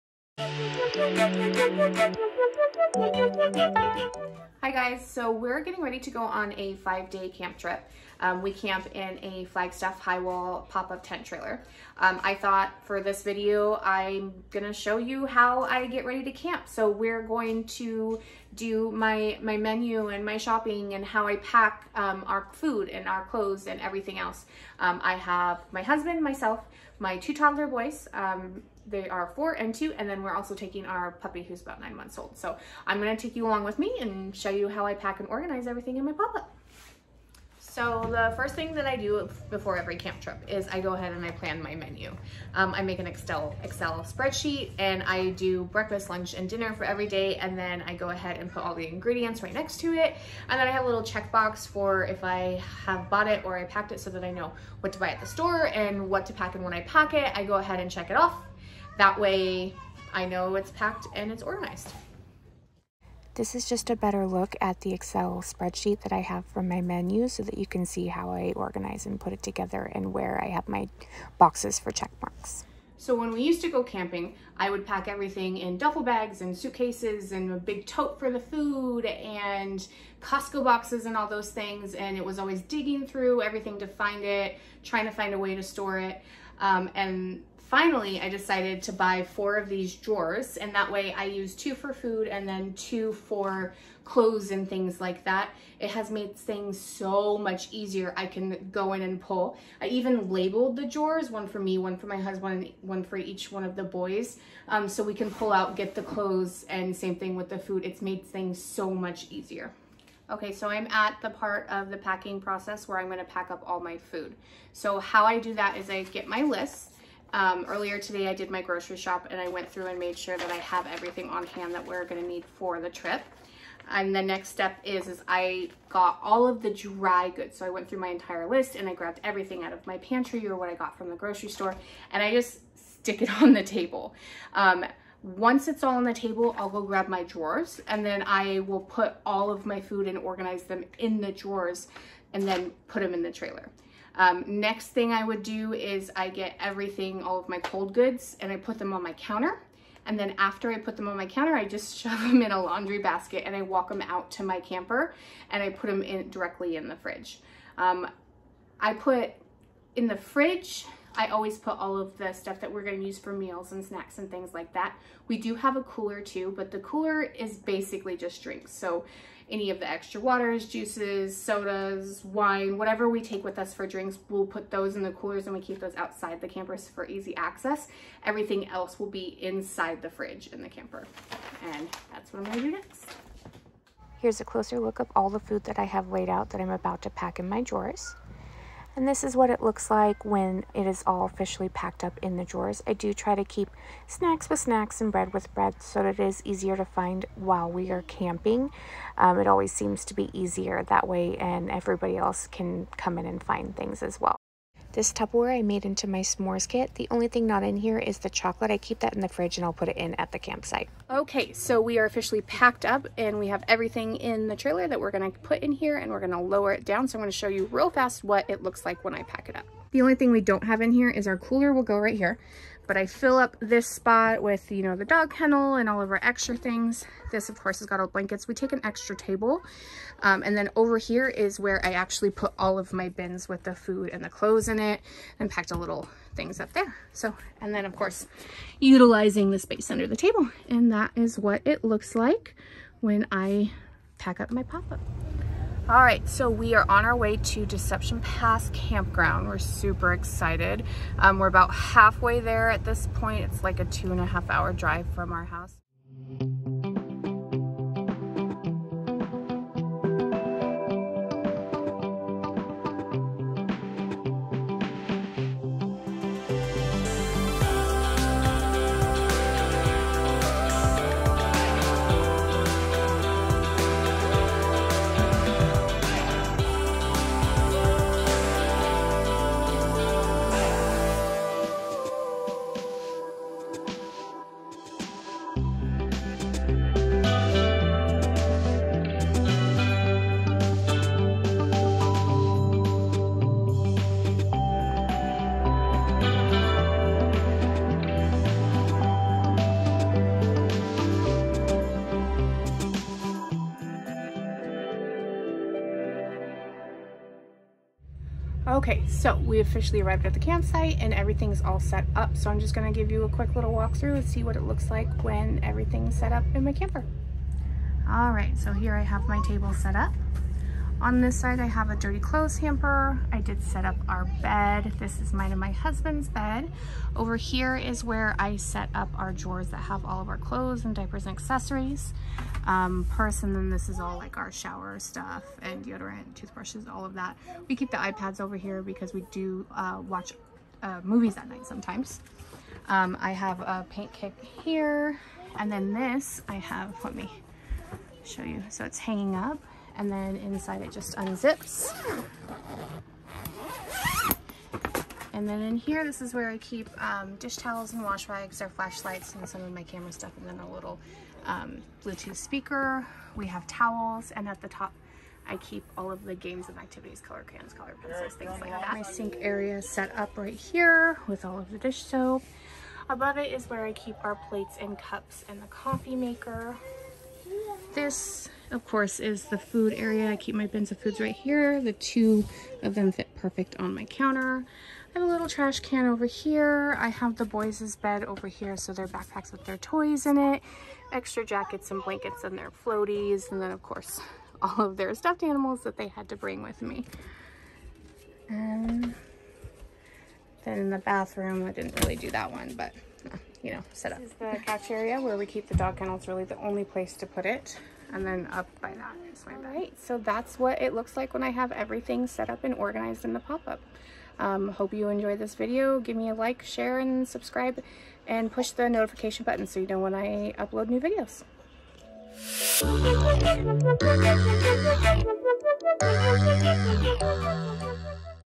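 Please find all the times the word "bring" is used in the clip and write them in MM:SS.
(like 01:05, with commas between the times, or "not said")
06:36.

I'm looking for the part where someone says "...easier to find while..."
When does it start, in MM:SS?
03:16.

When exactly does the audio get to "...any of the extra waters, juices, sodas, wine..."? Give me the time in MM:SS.
02:49.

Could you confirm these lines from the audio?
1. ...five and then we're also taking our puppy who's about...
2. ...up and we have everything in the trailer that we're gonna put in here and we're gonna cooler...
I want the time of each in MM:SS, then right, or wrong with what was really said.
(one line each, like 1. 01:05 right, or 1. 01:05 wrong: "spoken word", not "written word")
1. 00:29 wrong: "two", not "five"
2. 03:32 wrong: "lower", not "cooler".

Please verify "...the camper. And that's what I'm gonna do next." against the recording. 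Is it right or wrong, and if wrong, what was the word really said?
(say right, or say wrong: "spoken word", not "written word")
right.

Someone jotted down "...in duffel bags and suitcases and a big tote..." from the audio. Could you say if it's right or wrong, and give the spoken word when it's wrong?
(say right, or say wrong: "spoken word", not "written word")
right.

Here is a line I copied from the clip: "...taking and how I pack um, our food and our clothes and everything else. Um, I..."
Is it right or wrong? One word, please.
wrong.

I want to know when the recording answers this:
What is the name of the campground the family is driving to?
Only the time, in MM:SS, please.
04:07.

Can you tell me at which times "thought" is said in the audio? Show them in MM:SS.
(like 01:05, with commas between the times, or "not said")
00:12.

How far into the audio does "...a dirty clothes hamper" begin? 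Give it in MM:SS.
05:21.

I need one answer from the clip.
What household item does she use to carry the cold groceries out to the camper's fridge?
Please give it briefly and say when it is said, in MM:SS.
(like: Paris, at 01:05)
Laundry basket, at 02:32.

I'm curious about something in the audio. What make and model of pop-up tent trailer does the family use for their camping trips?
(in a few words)
Flagstaff high wall.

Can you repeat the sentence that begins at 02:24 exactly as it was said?
Um, next thing I would do is I get everything, all of my cold goods, and I put them on my counter.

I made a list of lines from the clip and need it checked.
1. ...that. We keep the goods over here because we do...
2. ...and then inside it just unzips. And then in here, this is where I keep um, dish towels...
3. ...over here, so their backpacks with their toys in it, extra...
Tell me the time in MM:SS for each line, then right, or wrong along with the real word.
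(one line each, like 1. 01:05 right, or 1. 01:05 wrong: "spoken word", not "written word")
1. 05:37 wrong: "iPads", not "goods"
2. 05:50 right
3. 06:28 right.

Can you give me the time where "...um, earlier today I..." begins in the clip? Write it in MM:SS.
01:57.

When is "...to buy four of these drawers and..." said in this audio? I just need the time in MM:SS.
01:28.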